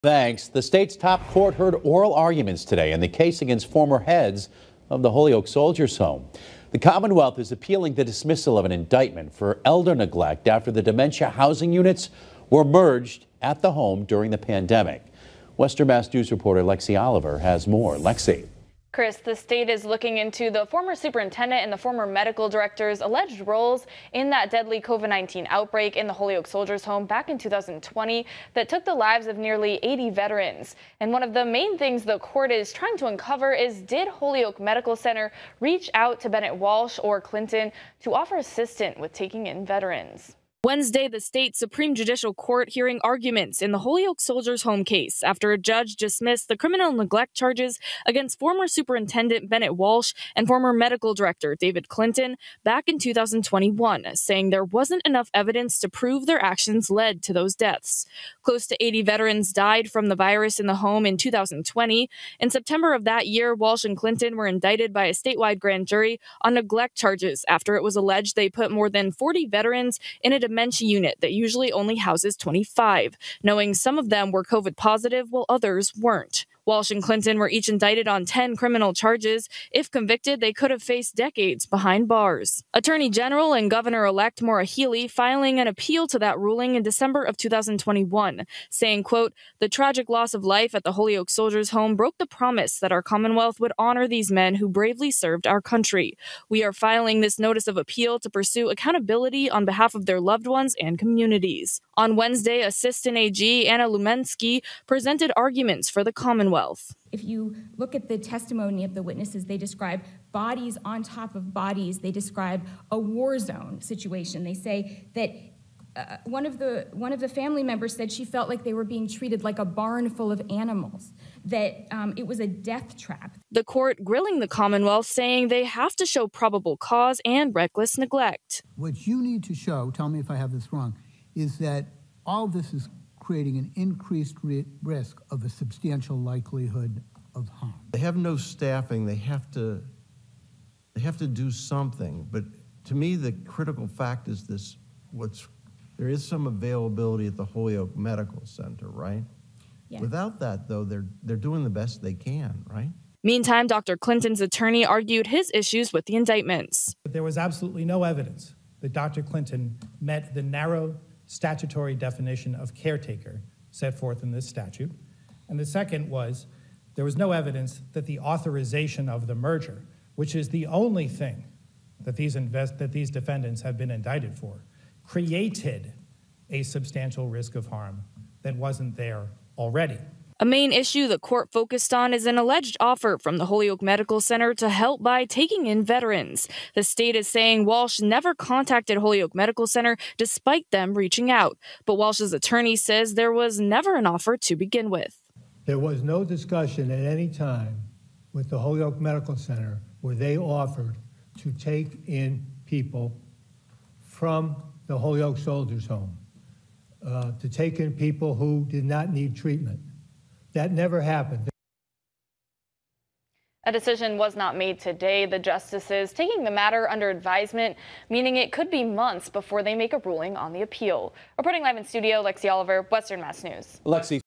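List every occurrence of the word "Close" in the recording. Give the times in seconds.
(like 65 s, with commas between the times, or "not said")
58 s.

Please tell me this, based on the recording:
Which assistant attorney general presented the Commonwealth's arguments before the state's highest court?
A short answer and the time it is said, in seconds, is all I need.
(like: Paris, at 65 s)
Anna Lumelsky, at 103 s.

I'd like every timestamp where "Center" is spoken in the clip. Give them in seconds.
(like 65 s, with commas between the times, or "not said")
34 s, 148 s, 184 s, 189 s, 199 s.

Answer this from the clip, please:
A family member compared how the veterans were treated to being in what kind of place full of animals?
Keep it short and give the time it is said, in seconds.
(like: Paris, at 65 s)
barn, at 119 s.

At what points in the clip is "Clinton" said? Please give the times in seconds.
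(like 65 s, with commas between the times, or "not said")
37 s, 51 s, 63 s, 77 s, 153 s, 159 s.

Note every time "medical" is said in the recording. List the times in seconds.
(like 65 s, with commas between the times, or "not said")
22 s, 34 s, 50 s, 147 s, 183 s, 189 s, 198 s.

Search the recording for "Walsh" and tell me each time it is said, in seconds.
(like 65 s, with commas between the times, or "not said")
36 s, 49 s, 63 s, 76 s, 187 s, 191 s.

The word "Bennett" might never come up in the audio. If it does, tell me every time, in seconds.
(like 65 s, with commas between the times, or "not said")
36 s, 49 s.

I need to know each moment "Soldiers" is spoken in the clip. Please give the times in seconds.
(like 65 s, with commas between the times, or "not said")
5 s, 26 s, 44 s, 91 s, 205 s.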